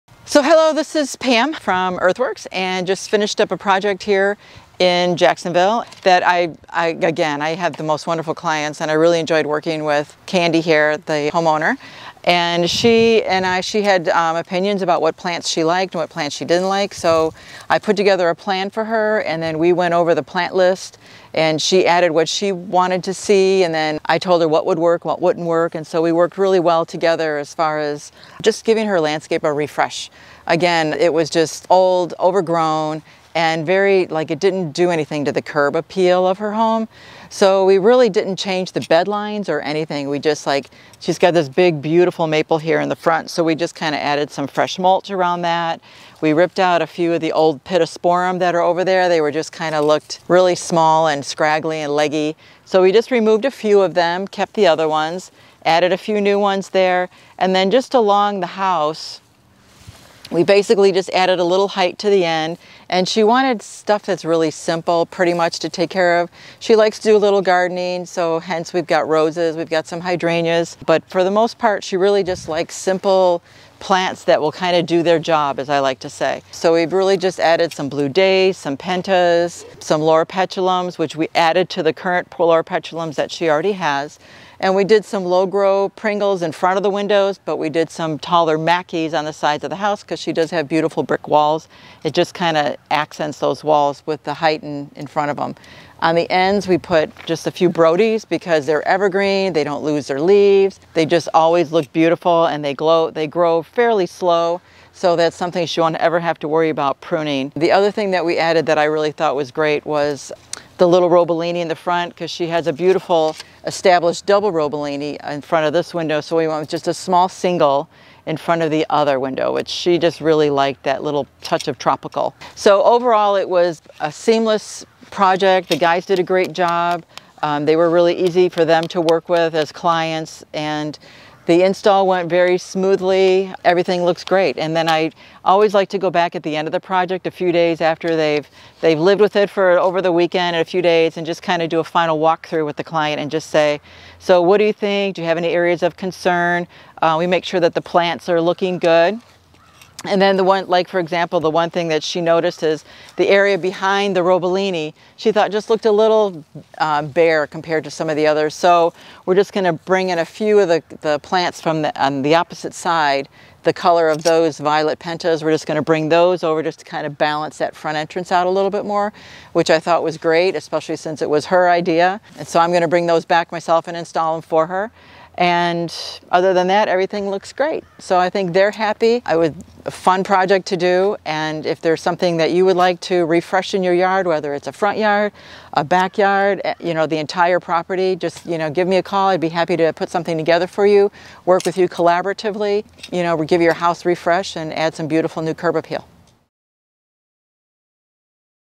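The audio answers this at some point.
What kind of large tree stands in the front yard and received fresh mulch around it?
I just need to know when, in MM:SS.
00:42.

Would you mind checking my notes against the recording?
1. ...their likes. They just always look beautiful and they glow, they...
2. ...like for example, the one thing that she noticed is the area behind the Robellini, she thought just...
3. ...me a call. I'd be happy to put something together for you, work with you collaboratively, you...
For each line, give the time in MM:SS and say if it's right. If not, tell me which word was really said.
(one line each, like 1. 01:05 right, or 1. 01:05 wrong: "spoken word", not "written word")
1. 01:40 wrong: "leaves", not "likes"
2. 02:30 right
3. 03:08 right.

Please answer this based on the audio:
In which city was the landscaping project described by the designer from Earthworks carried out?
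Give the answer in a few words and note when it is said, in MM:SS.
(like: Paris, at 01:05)
Jacksonville, at 00:05.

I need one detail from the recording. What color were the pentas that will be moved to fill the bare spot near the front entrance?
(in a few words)
Violet.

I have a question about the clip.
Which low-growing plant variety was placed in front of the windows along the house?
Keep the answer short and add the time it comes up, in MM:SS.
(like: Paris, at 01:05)
Pringles, at 01:25.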